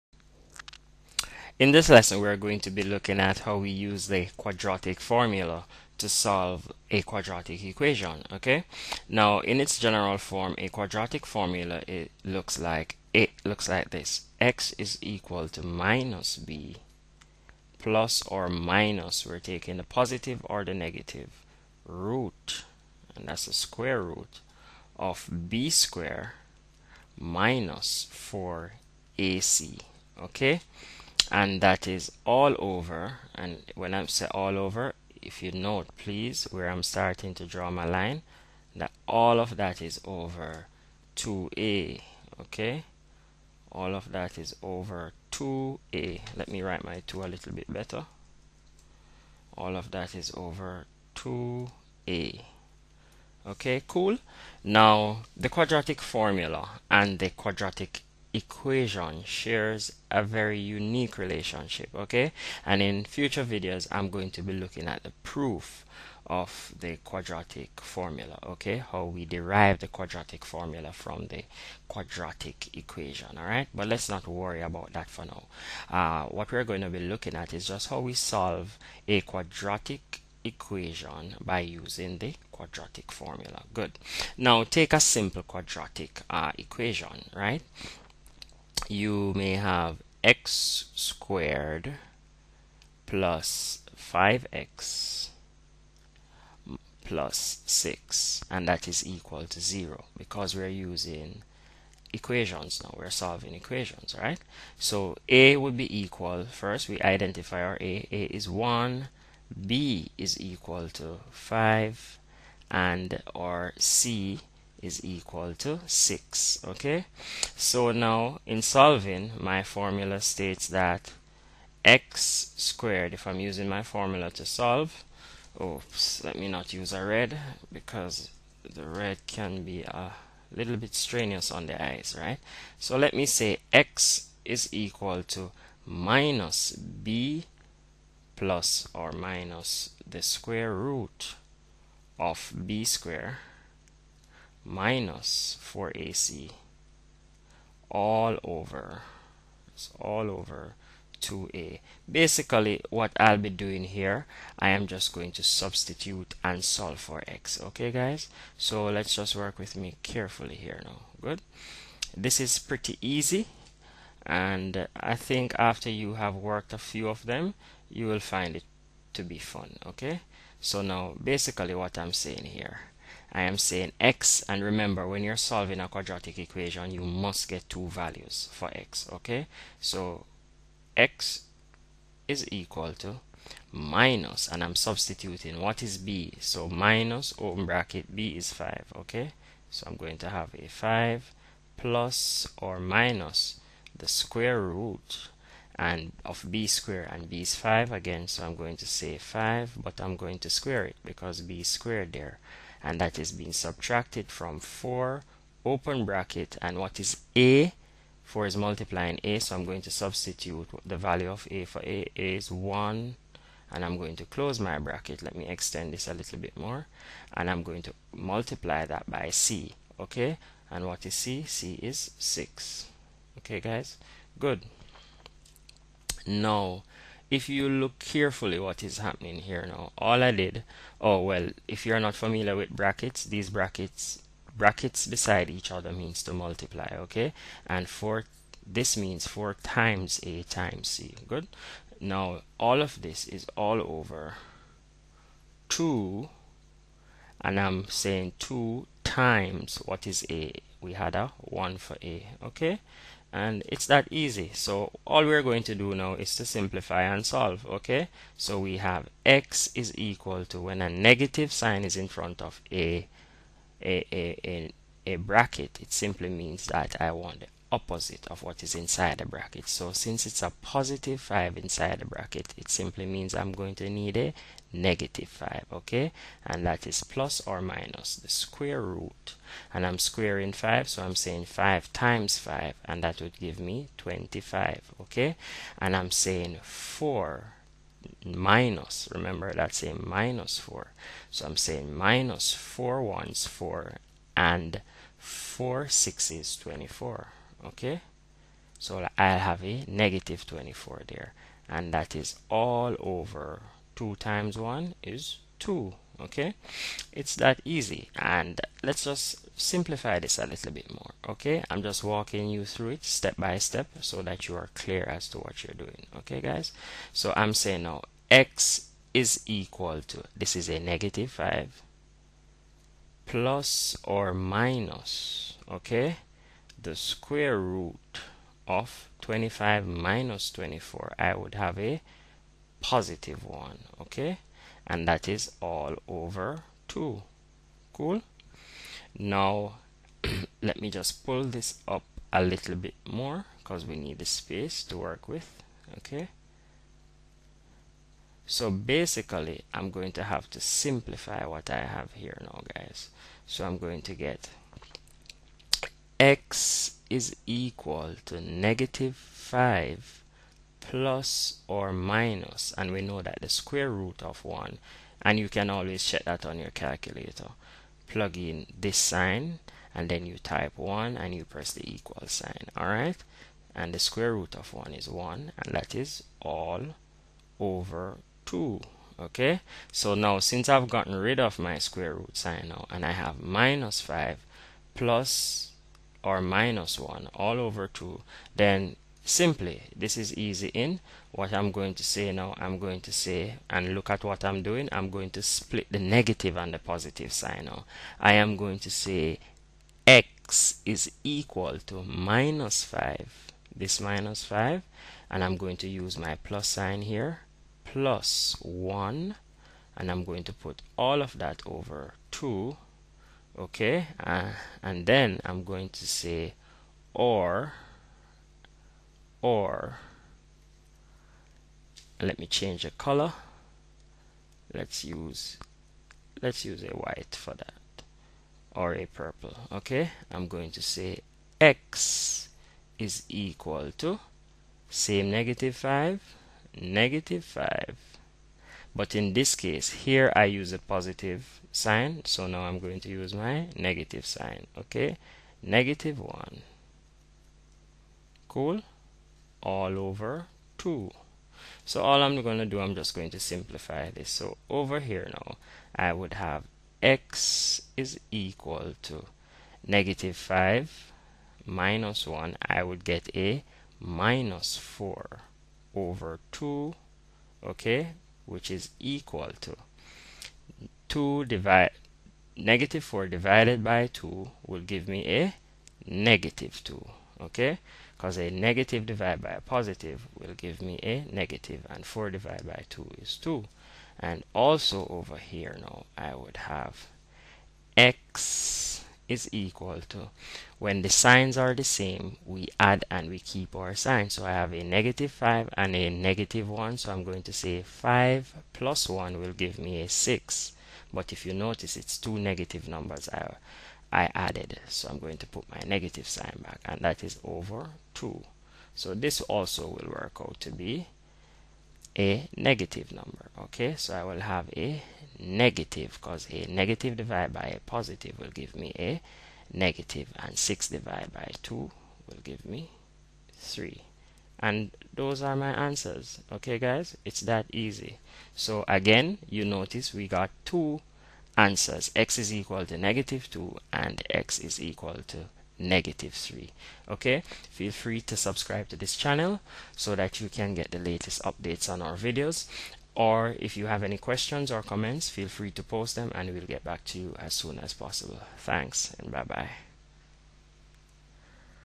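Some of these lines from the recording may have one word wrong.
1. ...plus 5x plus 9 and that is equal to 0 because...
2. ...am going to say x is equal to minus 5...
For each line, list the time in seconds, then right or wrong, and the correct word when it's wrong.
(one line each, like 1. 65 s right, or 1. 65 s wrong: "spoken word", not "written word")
1. 93 s wrong: "6", not "9"
2. 398 s right.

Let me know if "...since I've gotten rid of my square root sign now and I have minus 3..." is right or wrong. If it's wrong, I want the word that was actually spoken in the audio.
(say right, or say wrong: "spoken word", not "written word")
wrong: "5", not "3".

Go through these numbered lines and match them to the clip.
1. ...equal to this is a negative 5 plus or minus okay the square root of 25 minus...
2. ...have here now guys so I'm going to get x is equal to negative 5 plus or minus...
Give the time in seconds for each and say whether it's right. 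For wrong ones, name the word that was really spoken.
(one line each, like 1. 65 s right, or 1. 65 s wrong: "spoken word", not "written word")
1. 319 s right
2. 351 s right.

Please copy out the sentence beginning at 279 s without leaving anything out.
And I'm squaring 5, so I'm saying 5 times 5, and that would give me 25, okay?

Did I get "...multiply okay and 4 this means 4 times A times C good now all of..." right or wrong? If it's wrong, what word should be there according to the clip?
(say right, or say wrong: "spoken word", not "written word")
right.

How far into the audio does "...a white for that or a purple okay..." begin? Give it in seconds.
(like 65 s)
426 s.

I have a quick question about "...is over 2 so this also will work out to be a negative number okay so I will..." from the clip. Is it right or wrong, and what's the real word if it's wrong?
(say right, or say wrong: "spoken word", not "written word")
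right.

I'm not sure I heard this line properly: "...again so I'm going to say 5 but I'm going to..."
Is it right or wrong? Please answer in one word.
right.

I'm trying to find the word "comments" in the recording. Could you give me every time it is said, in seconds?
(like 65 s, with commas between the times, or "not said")
544 s.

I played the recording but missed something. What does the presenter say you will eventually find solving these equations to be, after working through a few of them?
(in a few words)
fun.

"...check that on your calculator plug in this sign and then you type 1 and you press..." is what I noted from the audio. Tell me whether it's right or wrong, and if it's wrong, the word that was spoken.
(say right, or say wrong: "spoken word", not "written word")
right.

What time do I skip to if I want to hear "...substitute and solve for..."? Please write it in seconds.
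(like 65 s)
155 s.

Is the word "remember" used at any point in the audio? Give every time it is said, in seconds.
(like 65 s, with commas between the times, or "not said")
174 s, 289 s.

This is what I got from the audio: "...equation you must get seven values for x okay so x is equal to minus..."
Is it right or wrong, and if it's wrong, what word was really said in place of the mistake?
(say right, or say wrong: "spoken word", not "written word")
wrong: "two", not "seven".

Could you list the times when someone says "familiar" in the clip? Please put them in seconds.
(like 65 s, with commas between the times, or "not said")
232 s.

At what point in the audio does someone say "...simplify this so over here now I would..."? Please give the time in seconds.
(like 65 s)
453 s.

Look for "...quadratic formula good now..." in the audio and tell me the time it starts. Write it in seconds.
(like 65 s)
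82 s.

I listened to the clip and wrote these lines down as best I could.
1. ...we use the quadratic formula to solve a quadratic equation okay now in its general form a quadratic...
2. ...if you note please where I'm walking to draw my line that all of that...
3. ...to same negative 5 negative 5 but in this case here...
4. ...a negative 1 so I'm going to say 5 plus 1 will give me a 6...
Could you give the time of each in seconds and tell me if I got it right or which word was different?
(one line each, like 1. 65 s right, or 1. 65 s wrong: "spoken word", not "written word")
1. 3 s right
2. 35 s wrong: "starting", not "walking"
3. 433 s right
4. 495 s right.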